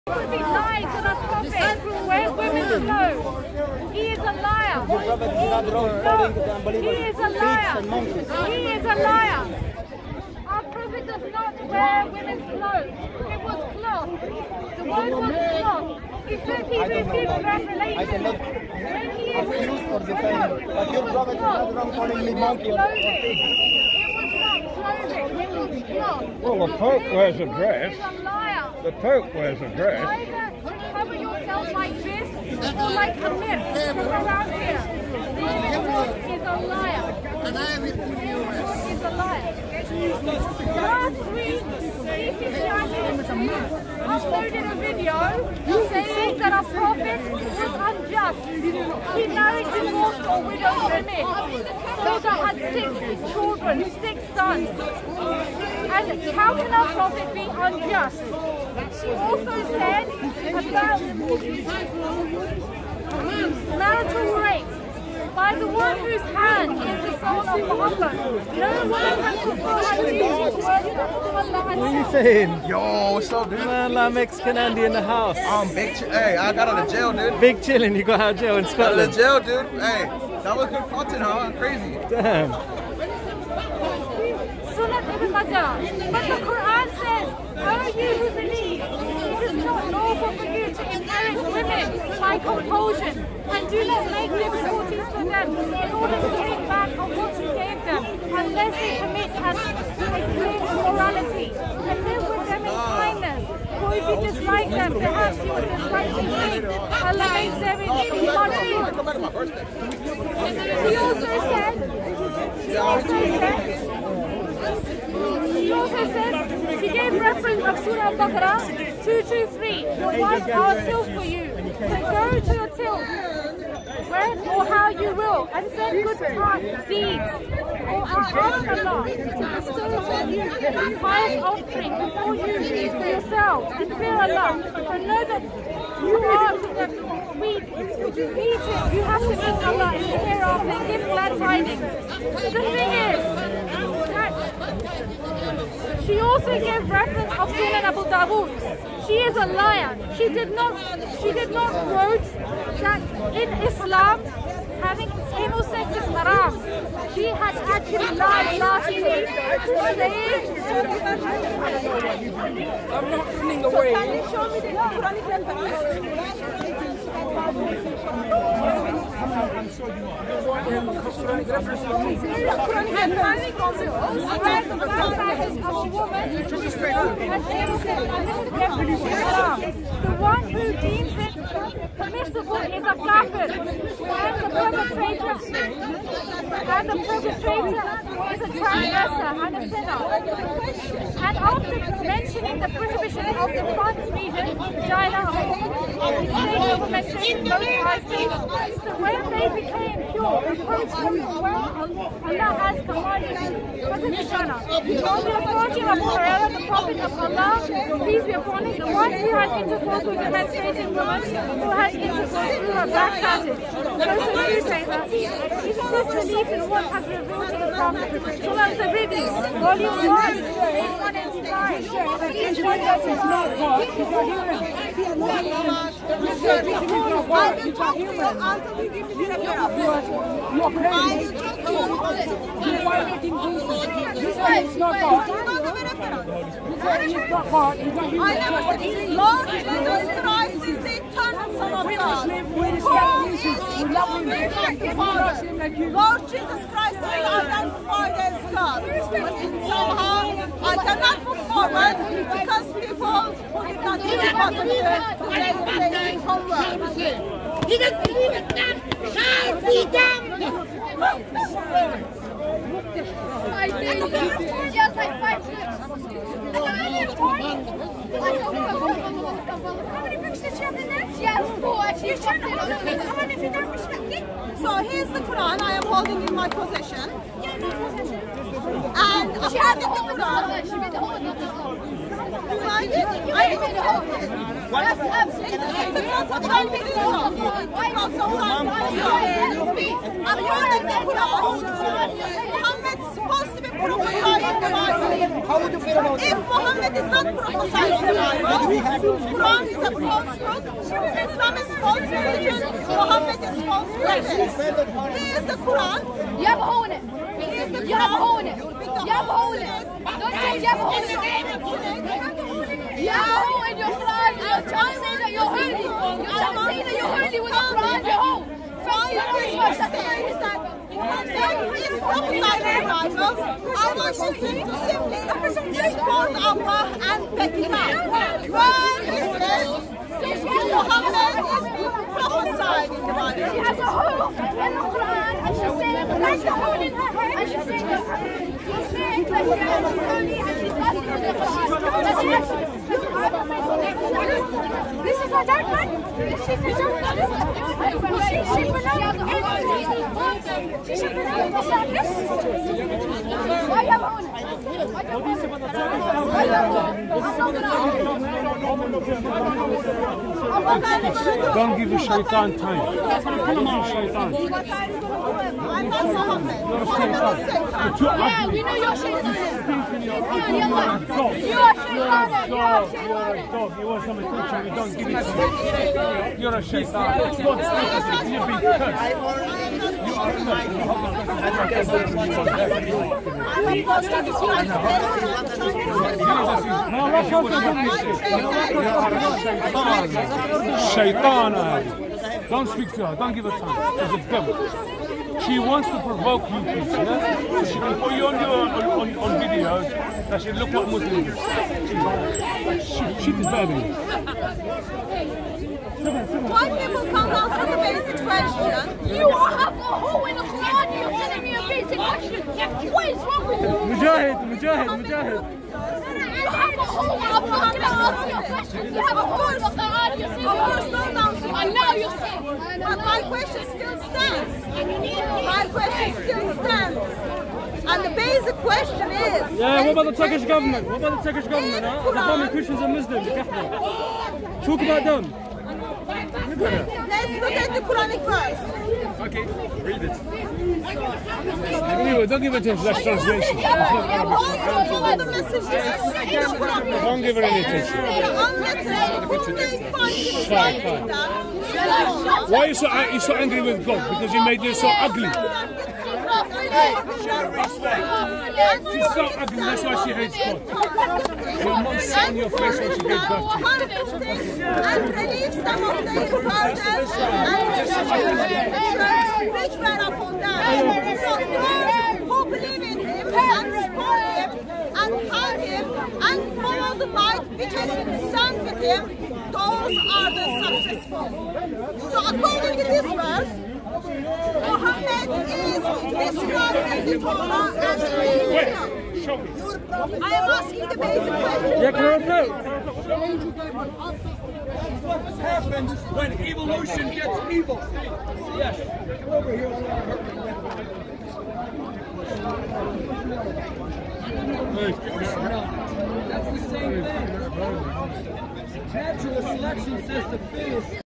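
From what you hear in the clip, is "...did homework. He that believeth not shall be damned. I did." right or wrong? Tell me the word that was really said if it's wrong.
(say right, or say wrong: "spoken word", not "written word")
right.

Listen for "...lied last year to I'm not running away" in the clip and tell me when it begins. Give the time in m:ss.
2:38.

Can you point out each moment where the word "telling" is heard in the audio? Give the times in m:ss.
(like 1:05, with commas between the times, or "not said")
6:51.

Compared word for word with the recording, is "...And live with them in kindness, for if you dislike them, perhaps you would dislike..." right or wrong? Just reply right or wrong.
right.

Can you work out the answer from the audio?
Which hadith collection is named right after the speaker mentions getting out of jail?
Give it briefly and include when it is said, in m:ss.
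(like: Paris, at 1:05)
Sunan ibn Majah, at 1:24.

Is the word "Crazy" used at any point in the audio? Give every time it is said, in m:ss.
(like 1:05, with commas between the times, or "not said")
1:21.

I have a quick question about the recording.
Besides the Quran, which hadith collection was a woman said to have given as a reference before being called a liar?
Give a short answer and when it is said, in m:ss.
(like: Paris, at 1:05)
Sunan Abu Dawood, at 2:27.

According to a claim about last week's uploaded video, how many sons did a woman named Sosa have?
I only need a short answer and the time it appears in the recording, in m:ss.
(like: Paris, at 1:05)
6, at 0:54.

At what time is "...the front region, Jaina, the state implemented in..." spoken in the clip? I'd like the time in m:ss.
3:13.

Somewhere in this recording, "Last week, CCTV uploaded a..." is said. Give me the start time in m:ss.
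0:40.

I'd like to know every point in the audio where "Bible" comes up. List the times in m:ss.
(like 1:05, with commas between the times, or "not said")
4:58, 5:22.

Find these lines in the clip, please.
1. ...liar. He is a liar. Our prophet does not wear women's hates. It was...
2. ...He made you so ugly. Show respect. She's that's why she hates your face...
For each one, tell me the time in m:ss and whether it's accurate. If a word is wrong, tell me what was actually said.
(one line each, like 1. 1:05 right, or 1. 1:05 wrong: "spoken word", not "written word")
1. 0:07 wrong: "clothes", not "hates"
2. 7:34 right.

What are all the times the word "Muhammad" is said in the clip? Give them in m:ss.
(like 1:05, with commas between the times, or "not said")
1:07, 4:52, 4:56, 5:02.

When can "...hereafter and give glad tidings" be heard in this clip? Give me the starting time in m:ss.
2:20.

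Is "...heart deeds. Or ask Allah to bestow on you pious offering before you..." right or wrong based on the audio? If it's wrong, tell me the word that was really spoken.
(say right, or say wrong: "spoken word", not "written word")
right.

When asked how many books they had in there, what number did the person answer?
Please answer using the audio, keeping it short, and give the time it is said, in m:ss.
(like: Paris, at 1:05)
4, at 4:31.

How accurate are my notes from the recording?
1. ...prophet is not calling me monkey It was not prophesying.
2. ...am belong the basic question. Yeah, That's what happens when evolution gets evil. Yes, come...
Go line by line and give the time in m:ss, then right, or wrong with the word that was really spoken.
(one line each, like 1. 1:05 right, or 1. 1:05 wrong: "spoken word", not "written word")
1. 0:21 wrong: "clothing", not "prophesying"
2. 8:10 wrong: "asking", not "belong".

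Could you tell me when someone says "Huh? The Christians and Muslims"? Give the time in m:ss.
7:11.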